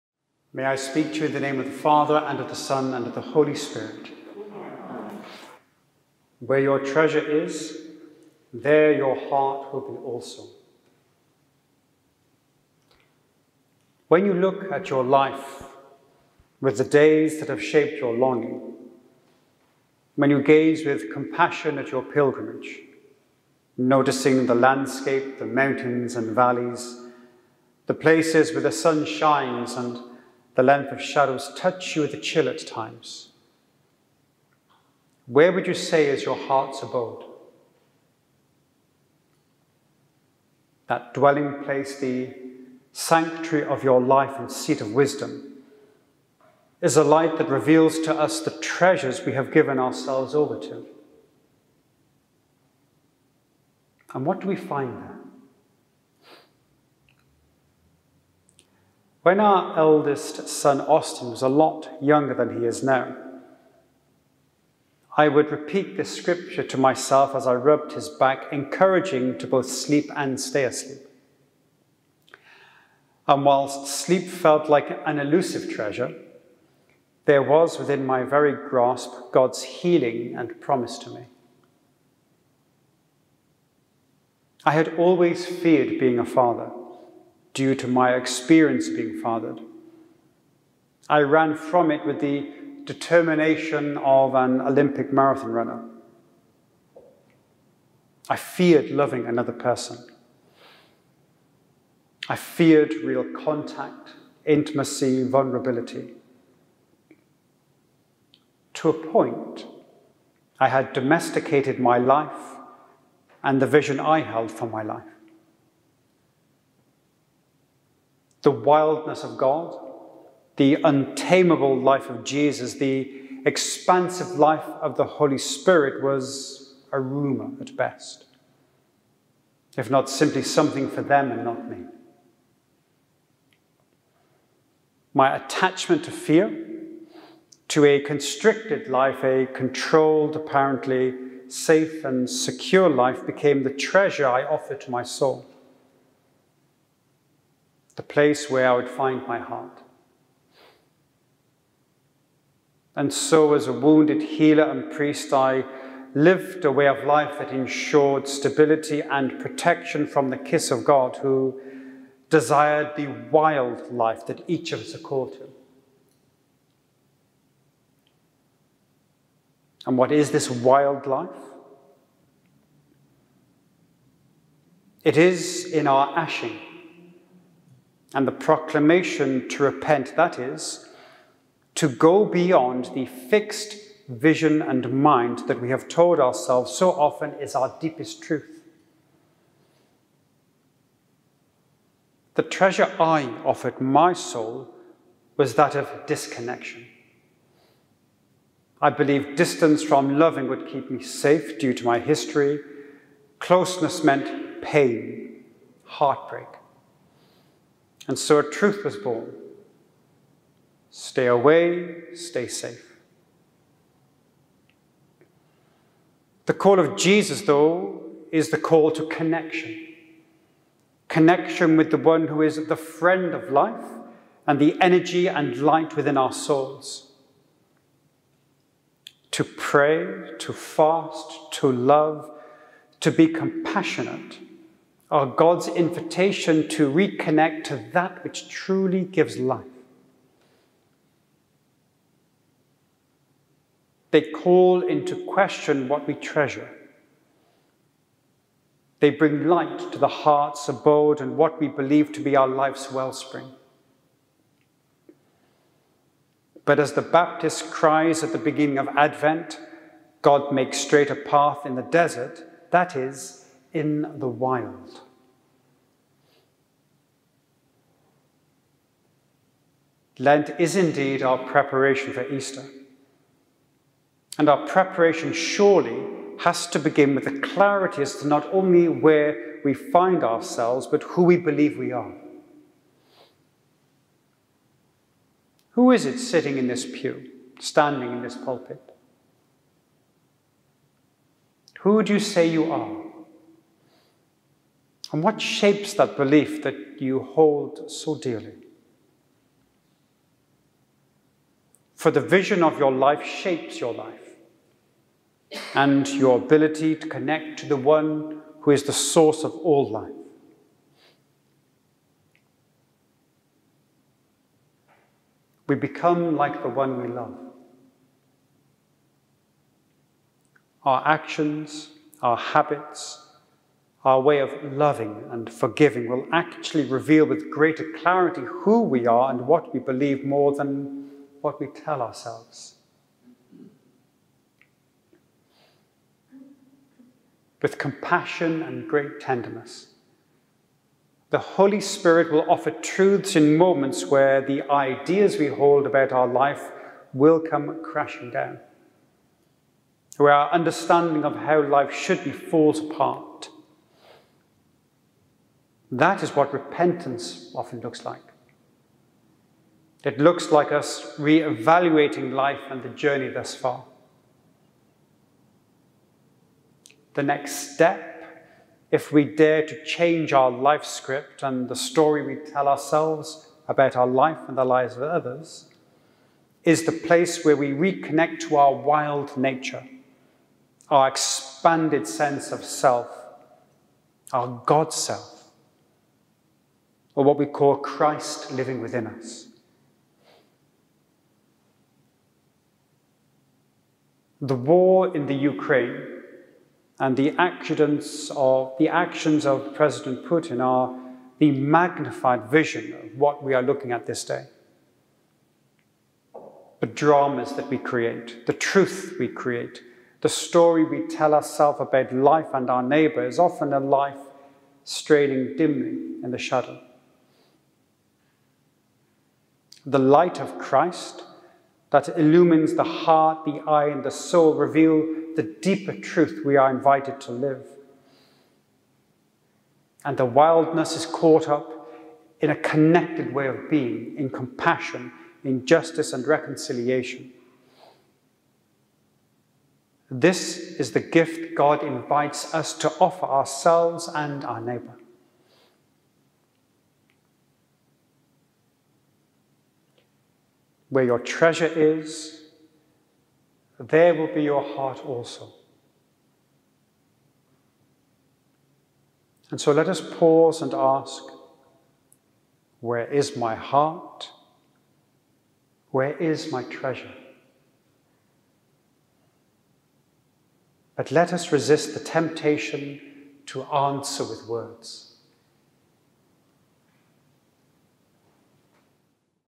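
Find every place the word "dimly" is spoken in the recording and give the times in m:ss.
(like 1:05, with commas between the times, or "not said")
6:55.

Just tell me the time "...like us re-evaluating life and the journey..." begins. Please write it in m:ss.
6:00.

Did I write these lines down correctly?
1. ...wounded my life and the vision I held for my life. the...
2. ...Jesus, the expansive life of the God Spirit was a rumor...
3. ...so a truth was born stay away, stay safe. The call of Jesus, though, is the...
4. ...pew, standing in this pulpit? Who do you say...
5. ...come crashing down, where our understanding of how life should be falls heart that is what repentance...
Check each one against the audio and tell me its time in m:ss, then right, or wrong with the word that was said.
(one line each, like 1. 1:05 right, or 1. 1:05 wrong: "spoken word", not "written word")
1. 1:50 wrong: "domesticated", not "wounded"
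2. 2:02 wrong: "Holy", not "God"
3. 3:28 right
4. 4:46 right
5. 5:47 wrong: "apart", not "heart".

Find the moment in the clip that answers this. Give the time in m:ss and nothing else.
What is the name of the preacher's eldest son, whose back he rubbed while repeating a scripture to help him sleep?
1:00.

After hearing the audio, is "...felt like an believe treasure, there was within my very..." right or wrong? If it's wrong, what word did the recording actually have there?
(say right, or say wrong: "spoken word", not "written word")
wrong: "elusive", not "believe".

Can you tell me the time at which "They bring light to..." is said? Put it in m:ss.
4:09.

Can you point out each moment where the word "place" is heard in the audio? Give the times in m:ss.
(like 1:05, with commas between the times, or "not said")
0:27, 0:41, 2:28, 6:16.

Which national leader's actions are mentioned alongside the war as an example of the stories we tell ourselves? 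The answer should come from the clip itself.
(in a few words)
President Putin.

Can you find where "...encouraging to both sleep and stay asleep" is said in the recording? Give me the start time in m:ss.
1:08.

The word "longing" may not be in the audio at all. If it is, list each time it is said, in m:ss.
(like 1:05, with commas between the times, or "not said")
0:18.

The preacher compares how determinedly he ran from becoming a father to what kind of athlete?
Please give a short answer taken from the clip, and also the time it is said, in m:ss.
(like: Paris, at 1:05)
Olympic marathon runner, at 1:34.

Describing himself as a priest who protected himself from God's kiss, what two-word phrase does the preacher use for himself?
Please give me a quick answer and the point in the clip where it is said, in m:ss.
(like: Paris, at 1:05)
wounded healer, at 2:33.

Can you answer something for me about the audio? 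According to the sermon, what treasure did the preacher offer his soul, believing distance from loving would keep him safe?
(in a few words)
disconnection.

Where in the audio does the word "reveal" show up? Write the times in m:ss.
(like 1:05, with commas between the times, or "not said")
0:47, 5:26, 7:04.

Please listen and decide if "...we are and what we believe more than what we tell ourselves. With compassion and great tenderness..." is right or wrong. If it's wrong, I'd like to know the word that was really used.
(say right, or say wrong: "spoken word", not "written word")
right.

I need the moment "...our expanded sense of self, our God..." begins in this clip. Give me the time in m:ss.
6:20.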